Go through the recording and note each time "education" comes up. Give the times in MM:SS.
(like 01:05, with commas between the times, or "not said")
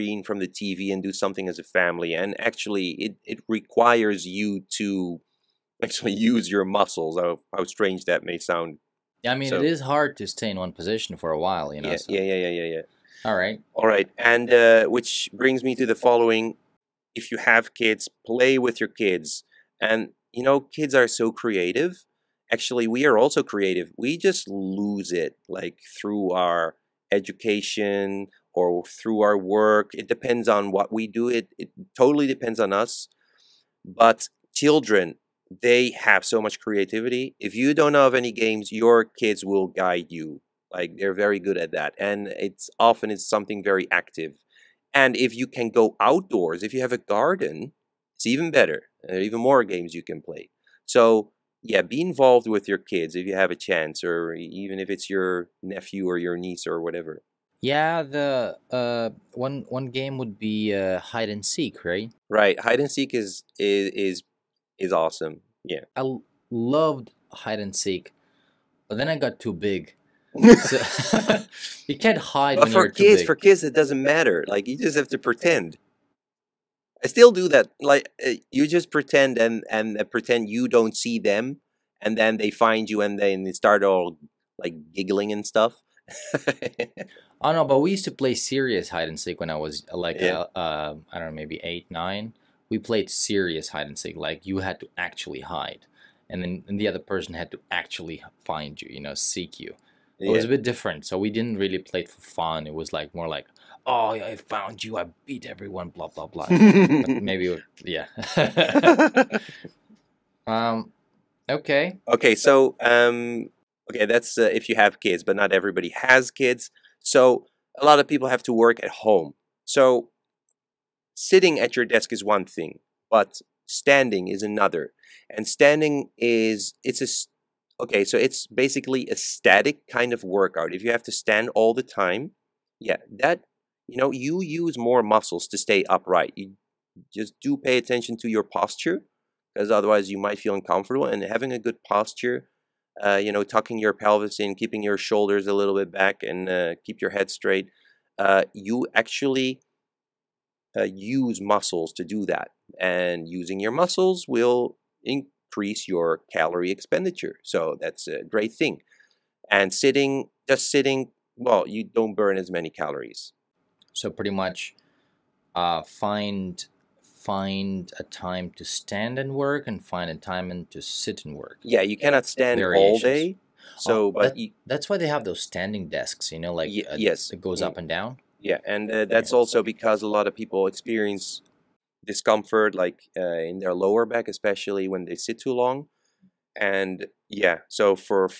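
00:27.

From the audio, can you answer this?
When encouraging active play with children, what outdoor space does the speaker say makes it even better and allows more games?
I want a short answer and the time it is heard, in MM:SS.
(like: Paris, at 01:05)
garden, at 00:47.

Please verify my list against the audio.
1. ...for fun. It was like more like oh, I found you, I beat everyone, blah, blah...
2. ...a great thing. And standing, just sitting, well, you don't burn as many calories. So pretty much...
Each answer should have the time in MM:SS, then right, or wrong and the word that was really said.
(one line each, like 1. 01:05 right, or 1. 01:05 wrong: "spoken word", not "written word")
1. 01:42 right
2. 02:38 wrong: "sitting", not "standing".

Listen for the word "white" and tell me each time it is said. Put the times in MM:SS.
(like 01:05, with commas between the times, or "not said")
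not said.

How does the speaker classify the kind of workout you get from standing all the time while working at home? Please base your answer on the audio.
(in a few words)
static.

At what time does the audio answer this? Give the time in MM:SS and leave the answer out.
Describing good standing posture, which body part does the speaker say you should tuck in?
02:23.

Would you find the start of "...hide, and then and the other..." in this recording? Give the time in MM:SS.
01:35.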